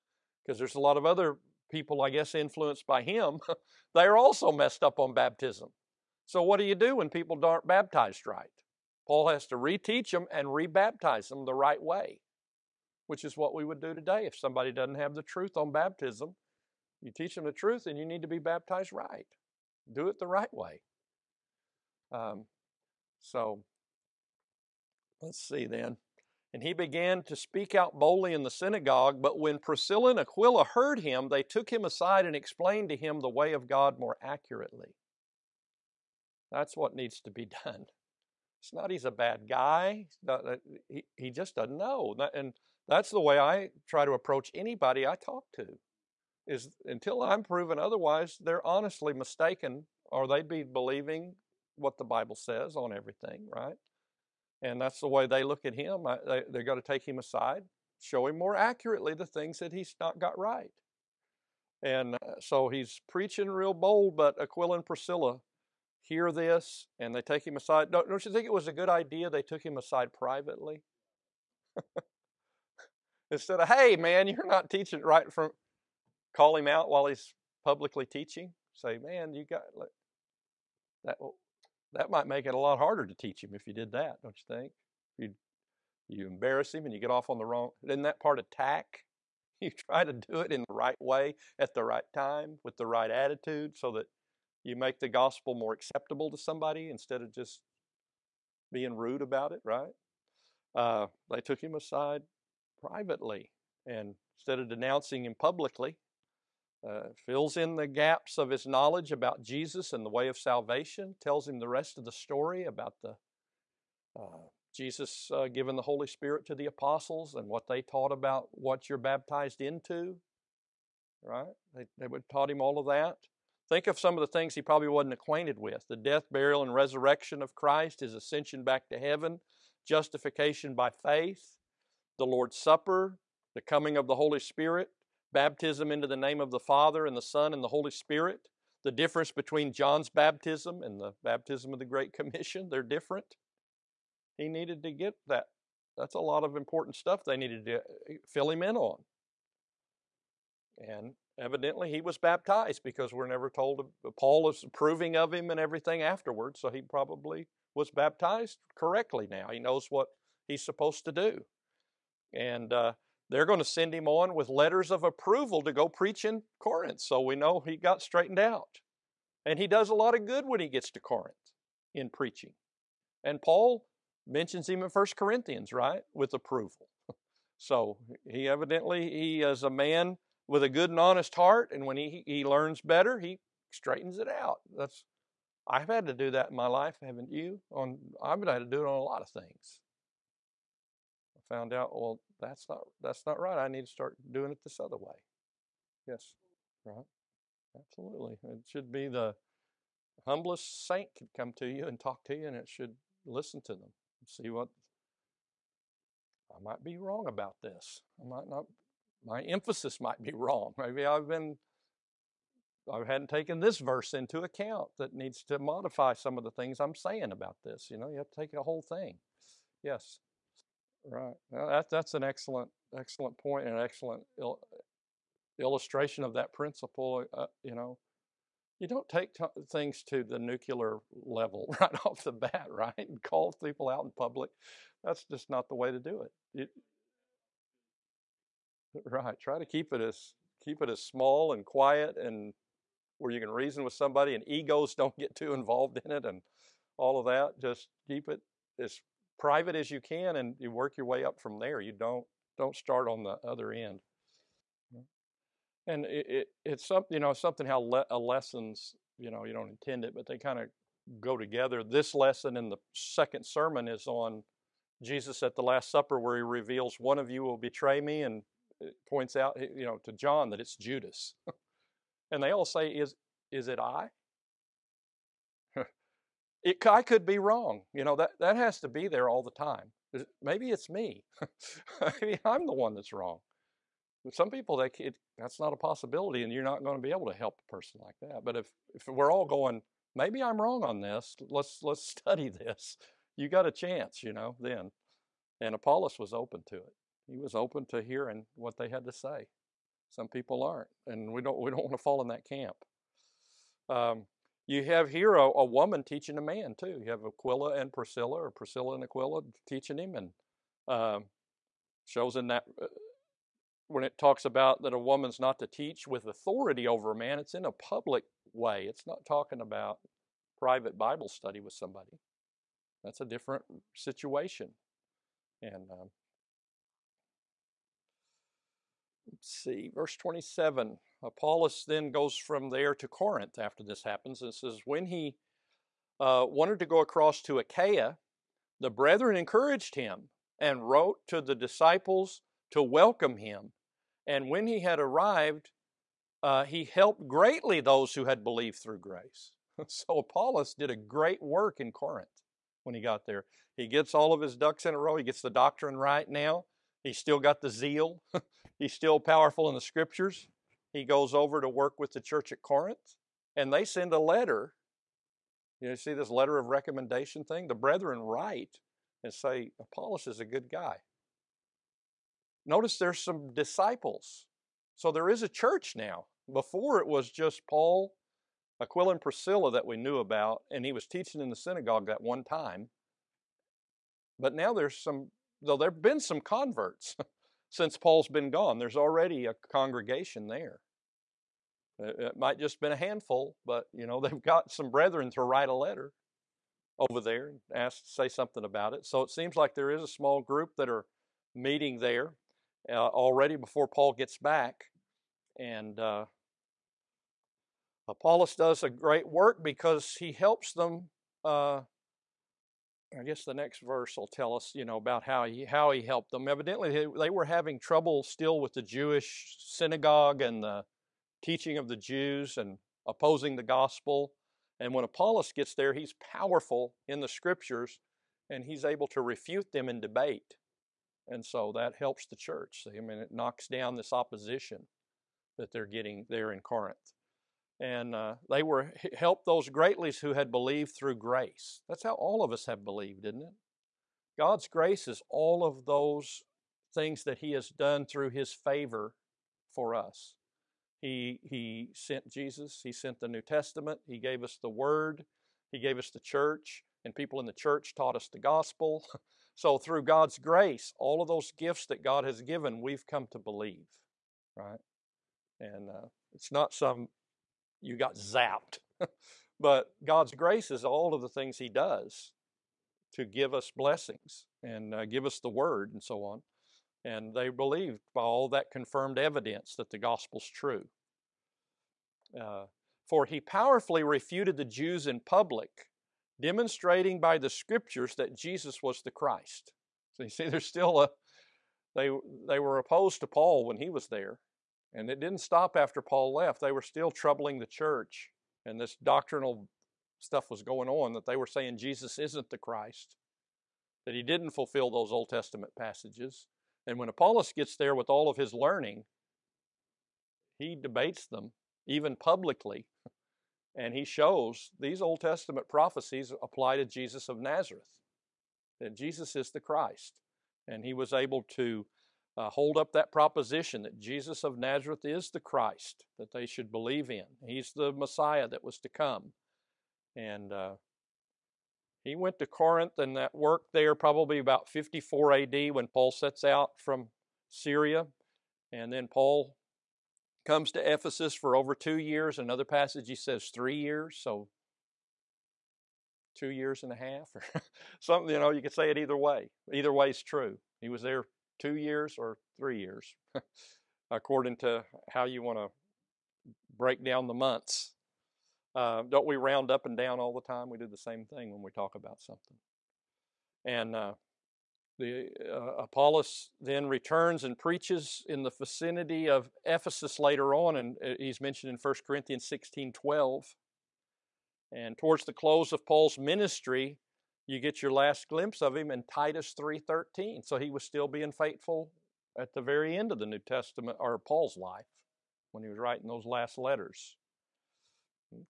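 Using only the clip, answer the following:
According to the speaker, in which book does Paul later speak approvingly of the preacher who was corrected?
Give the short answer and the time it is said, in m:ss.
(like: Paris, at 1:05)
First Corinthians, at 2:54.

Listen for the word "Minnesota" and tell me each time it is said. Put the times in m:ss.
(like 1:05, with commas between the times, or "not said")
not said.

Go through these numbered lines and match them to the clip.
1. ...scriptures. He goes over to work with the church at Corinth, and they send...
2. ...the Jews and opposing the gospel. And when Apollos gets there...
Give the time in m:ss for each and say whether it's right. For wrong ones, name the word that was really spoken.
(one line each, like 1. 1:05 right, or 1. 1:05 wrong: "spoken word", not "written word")
1. 5:59 right
2. 7:01 right.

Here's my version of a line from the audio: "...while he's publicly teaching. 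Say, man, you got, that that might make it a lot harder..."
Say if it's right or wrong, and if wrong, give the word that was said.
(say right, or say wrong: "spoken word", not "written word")
right.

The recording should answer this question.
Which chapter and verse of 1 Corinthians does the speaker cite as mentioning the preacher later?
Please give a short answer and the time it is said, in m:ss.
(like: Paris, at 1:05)
16:12, at 9:32.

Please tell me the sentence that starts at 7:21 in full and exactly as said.
That's how all of us have believed, isn't it?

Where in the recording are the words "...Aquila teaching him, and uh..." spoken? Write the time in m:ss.
5:09.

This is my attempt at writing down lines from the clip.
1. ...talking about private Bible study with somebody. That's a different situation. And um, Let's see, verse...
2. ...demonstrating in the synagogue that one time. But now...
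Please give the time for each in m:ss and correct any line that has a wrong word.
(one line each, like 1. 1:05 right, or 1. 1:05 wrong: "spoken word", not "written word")
1. 5:19 right
2. 6:21 wrong: "teaching", not "demonstrating".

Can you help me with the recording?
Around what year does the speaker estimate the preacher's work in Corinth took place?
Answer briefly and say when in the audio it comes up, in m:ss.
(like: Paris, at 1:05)
54 AD, at 8:54.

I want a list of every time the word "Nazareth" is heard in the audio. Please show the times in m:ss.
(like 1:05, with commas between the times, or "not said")
8:37, 8:44.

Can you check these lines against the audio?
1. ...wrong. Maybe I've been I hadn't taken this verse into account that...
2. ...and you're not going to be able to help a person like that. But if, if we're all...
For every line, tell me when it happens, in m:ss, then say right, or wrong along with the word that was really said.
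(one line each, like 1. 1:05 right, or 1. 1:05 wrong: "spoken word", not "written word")
1. 3:30 right
2. 4:46 right.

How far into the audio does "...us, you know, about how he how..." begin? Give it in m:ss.
6:54.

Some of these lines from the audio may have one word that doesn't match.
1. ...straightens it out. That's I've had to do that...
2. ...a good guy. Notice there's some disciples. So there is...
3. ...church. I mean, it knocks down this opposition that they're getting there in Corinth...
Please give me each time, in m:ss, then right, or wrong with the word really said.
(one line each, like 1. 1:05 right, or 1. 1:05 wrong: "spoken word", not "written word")
1. 3:03 right
2. 6:10 right
3. 7:12 right.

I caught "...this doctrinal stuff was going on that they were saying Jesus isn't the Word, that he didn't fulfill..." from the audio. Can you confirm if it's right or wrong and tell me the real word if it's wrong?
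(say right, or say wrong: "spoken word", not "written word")
wrong: "Christ", not "Word".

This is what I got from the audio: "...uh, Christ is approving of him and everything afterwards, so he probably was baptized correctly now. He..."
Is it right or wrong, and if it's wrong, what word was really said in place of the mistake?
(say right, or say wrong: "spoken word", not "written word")
wrong: "Paul", not "Christ".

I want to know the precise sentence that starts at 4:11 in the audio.
You don't don't start on the other end.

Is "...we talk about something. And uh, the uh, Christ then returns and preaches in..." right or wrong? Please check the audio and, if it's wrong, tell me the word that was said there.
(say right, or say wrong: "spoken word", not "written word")
wrong: "Apollos", not "Christ".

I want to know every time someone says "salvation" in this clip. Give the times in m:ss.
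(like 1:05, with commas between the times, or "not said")
1:50.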